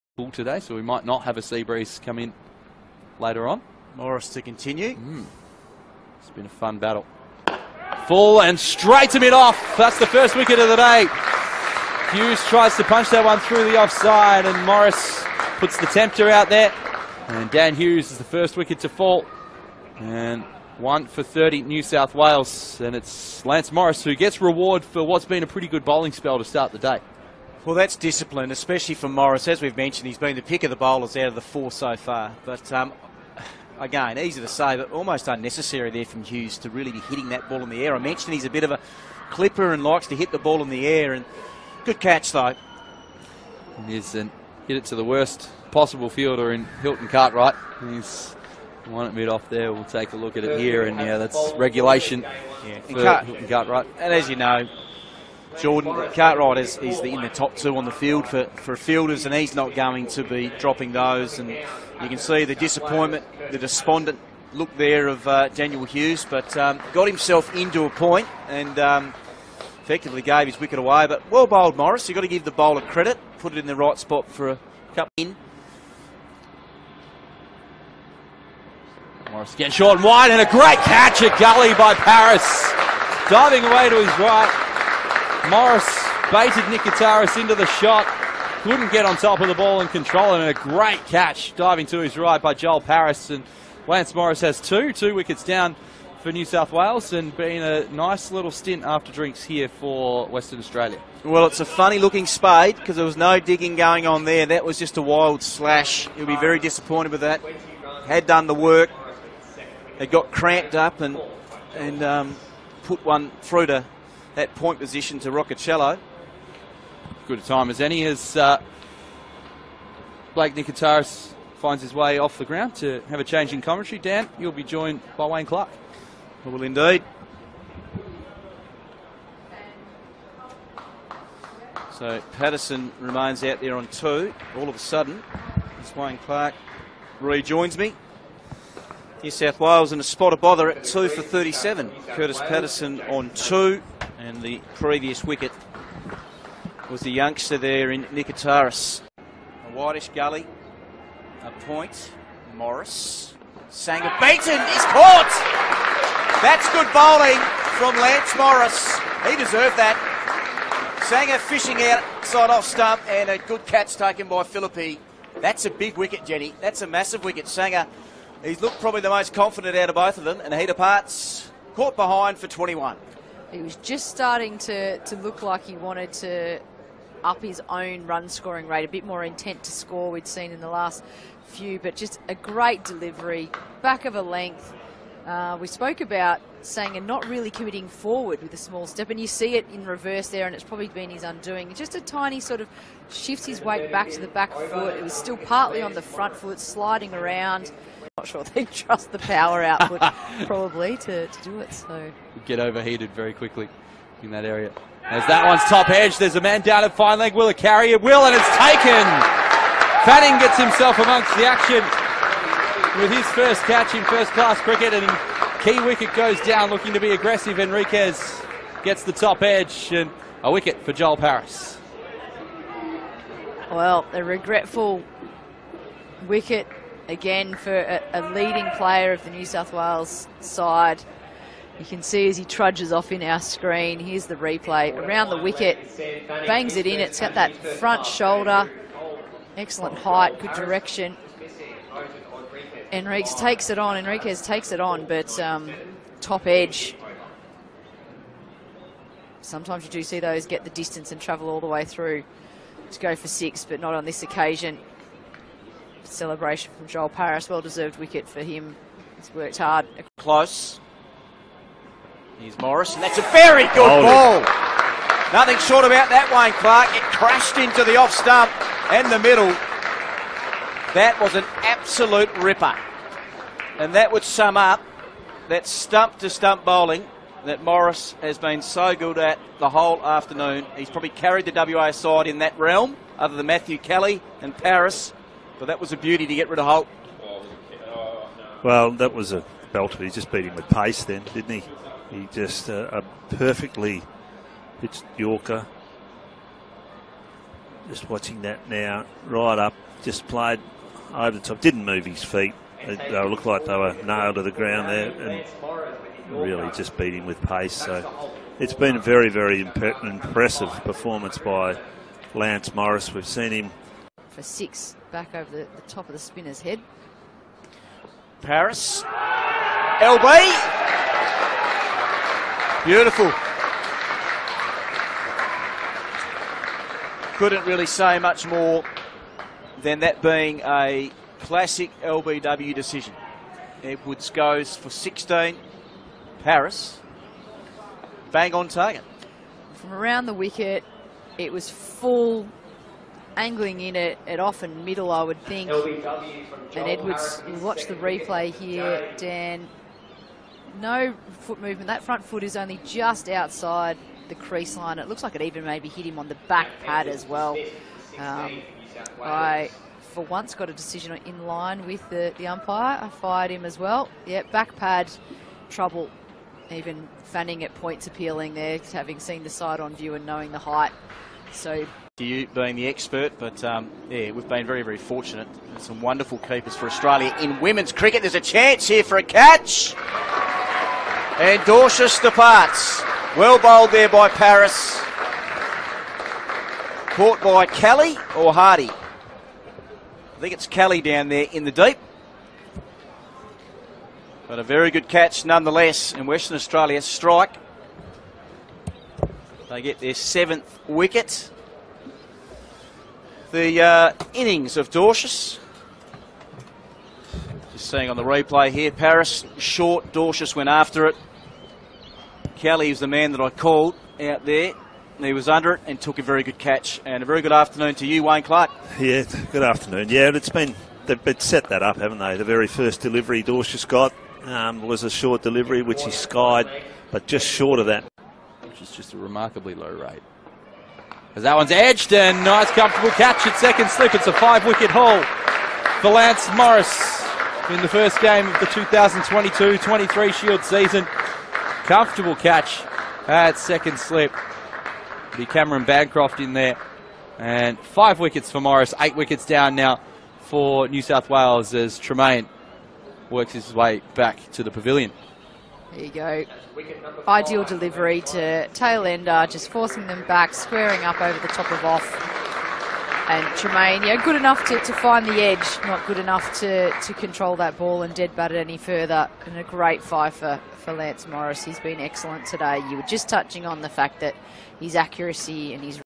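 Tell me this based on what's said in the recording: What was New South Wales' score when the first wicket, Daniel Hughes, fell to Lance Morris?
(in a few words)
1 for 30.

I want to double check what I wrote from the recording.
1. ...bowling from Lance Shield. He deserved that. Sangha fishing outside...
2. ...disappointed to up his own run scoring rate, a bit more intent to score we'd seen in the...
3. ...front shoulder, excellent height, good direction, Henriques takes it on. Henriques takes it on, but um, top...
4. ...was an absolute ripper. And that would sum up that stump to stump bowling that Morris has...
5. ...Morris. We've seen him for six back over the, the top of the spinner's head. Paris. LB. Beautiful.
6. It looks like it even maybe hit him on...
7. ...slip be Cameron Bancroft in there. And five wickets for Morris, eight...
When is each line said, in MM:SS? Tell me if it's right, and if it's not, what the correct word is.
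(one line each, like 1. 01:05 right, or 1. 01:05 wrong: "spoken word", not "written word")
1. 02:36 wrong: "Morris", not "Shield"
2. 02:55 wrong: "wanted", not "disappointed"
3. 03:57 right
4. 04:31 right
5. 05:12 right
6. 05:54 right
7. 07:23 right.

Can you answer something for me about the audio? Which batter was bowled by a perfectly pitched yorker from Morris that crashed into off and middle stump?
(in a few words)
Holt.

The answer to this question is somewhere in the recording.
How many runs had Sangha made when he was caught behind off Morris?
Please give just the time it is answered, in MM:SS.
02:52.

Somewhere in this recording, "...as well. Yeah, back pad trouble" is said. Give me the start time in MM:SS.
06:03.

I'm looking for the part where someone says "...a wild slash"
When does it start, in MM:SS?
01:44.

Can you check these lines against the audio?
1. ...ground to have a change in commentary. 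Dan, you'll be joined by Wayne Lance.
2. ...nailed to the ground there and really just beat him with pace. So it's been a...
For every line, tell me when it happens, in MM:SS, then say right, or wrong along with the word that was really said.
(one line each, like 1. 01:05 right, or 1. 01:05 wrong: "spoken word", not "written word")
1. 02:02 wrong: "Clark", not "Lance"
2. 05:04 right.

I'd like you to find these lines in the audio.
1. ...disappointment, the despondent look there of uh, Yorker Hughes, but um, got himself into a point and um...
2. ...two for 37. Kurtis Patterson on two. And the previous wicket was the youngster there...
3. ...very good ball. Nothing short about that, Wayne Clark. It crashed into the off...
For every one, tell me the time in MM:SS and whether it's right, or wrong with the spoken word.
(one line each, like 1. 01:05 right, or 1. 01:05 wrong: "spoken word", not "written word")
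1. 01:02 wrong: "Daniel", not "Yorker"
2. 02:20 right
3. 04:23 right.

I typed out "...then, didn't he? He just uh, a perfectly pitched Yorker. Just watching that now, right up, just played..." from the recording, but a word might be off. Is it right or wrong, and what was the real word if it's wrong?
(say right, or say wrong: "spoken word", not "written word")
right.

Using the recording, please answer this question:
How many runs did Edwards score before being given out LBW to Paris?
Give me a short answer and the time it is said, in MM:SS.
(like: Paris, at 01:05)
16, at 05:34.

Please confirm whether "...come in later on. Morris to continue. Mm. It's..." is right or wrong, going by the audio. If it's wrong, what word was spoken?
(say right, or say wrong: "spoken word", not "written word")
right.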